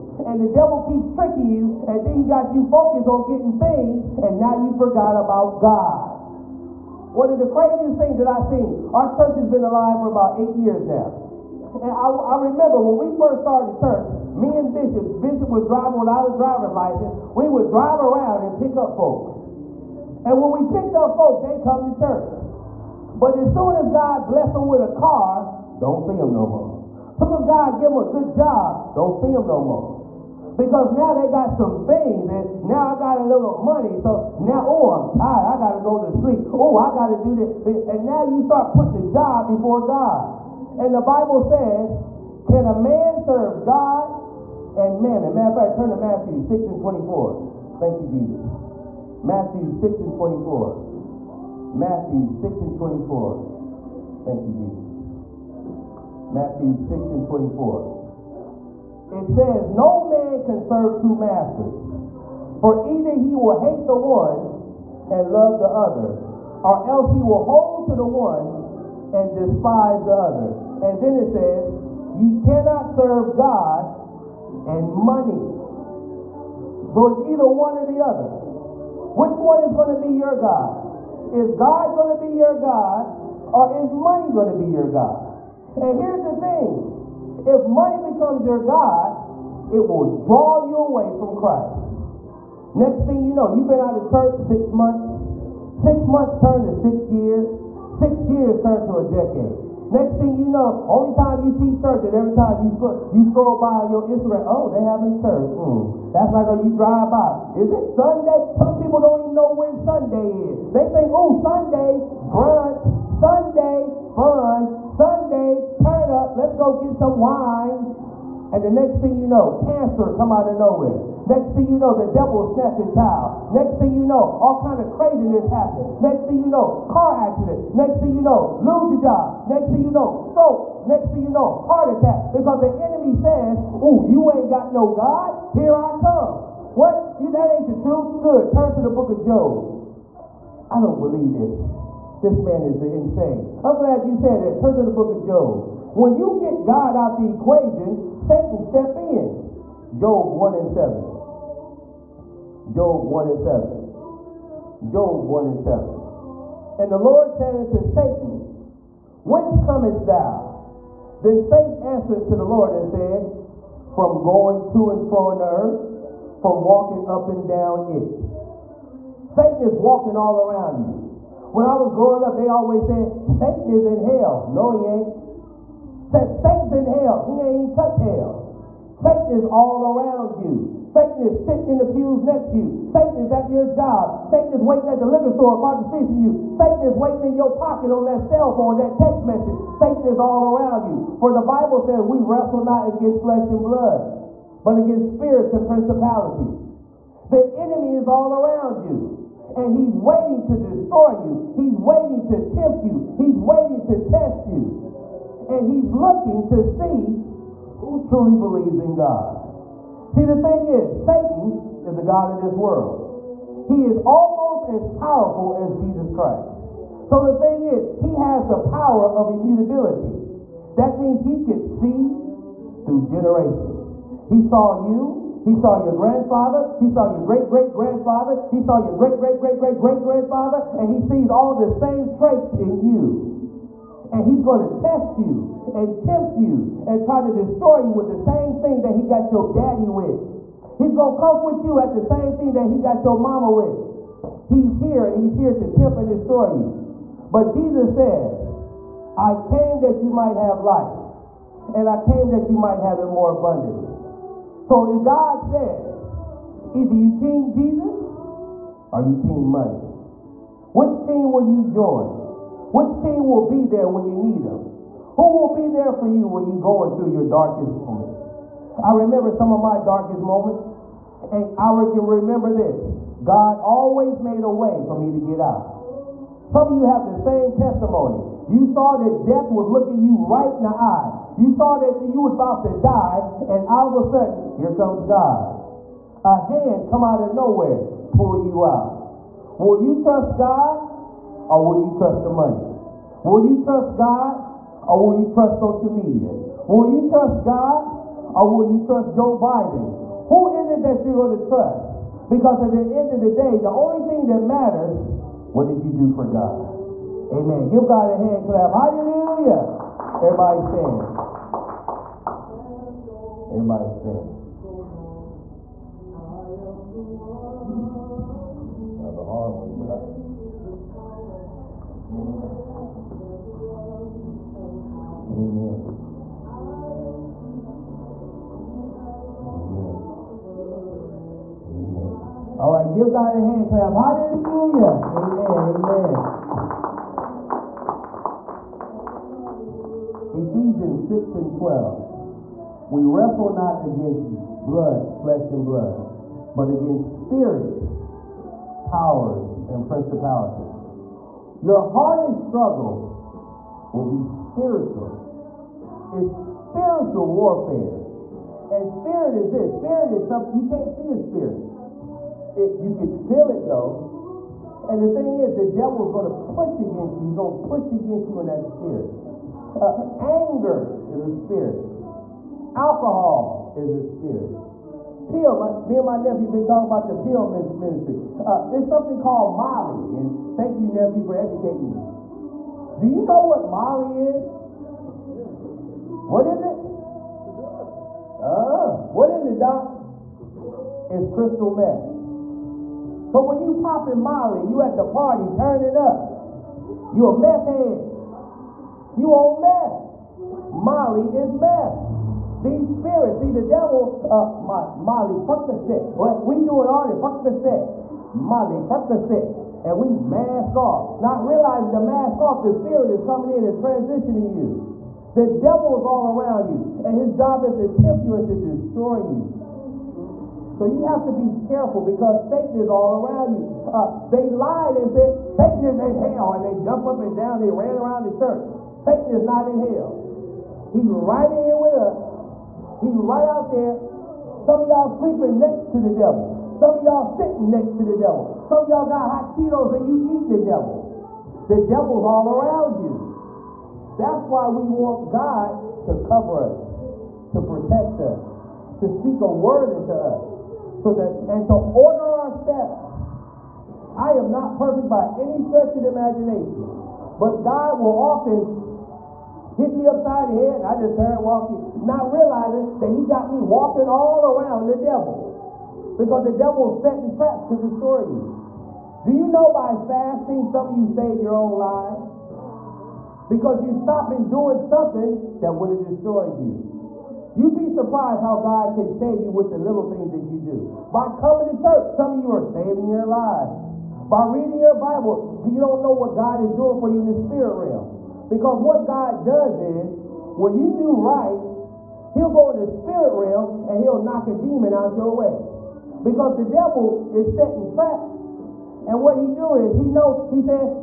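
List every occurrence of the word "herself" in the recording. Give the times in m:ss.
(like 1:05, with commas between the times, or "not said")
not said.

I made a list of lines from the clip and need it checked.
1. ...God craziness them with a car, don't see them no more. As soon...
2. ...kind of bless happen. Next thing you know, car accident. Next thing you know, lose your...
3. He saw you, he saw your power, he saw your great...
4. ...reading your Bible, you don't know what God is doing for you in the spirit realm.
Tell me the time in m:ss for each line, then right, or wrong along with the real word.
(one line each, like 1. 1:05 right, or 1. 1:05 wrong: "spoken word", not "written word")
1. 0:23 wrong: "bless", not "craziness"
2. 2:04 wrong: "craziness", not "bless"
3. 3:44 wrong: "grandfather", not "power"
4. 8:04 right.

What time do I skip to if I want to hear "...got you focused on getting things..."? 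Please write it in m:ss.
0:02.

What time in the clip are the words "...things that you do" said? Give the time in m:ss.
8:00.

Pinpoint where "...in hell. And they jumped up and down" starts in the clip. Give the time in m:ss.
7:05.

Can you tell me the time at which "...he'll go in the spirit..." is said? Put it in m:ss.
8:12.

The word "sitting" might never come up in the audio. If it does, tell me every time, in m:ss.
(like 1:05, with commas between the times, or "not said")
3:01, 7:17.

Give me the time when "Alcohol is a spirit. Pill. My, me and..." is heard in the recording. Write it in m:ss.
6:12.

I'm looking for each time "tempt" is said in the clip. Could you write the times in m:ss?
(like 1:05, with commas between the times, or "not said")
3:22, 3:56, 4:05, 6:58.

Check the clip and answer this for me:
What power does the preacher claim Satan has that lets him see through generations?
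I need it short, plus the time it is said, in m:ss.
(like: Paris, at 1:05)
immutability, at 3:39.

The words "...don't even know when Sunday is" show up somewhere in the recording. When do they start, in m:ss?
1:48.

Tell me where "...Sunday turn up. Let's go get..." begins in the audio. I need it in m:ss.
1:54.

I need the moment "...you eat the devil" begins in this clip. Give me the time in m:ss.
7:20.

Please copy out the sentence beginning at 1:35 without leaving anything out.
Six months turned to six years.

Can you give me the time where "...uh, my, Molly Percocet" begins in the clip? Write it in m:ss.
6:44.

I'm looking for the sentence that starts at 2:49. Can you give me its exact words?
Satan is walking all around you.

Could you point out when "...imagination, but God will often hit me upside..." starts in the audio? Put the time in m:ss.
7:36.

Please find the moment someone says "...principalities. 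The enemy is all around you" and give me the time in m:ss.
3:15.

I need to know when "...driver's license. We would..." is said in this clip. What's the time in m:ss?
0:16.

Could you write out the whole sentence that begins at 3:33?
He is almost as powerful as Jesus Christ.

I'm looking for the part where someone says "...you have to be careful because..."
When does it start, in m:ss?
7:00.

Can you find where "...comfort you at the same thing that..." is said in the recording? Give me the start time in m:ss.
4:01.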